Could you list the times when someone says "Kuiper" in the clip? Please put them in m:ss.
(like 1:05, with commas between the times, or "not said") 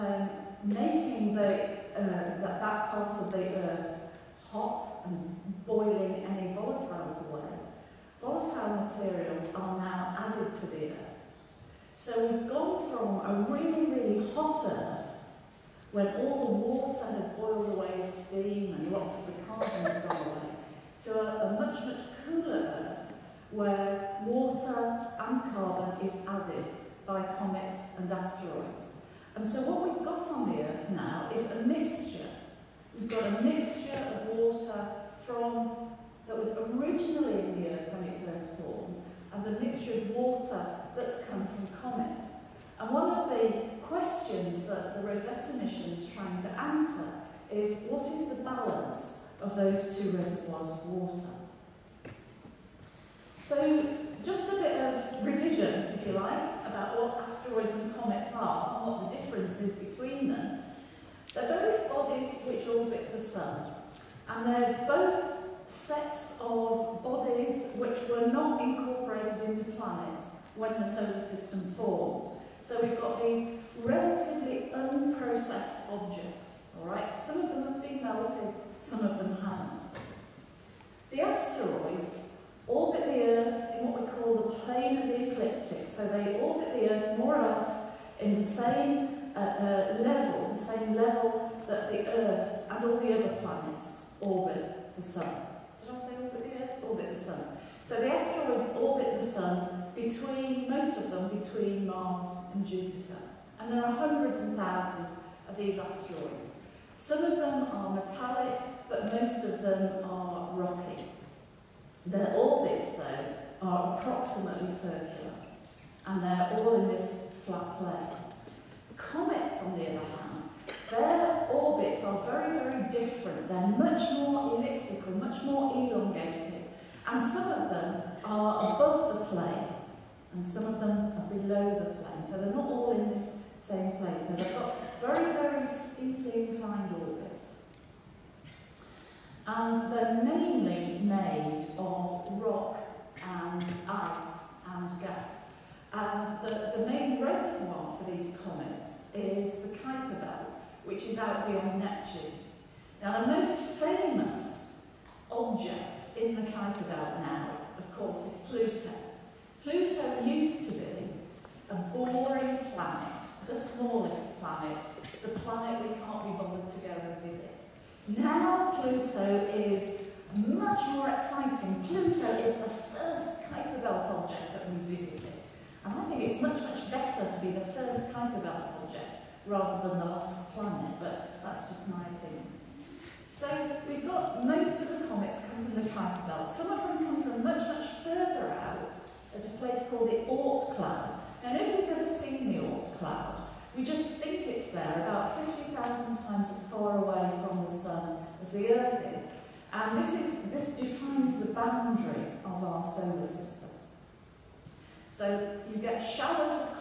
2:29, 2:36, 2:53, 2:58, 3:05.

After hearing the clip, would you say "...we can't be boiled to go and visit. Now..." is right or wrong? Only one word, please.
wrong.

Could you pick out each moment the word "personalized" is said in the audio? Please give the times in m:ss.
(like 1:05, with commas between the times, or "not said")
not said.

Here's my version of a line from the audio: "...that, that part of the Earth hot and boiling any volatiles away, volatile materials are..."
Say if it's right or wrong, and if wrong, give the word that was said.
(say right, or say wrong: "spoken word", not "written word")
right.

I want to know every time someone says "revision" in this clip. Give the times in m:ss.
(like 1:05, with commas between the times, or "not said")
0:55.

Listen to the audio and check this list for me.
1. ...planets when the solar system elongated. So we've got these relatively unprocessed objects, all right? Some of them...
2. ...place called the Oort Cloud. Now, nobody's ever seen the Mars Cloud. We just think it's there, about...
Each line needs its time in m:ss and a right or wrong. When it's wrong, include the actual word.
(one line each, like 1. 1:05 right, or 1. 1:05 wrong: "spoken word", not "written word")
1. 1:09 wrong: "formed", not "elongated"
2. 3:09 wrong: "Oort", not "Mars".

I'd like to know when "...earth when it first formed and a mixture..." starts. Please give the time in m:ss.
0:37.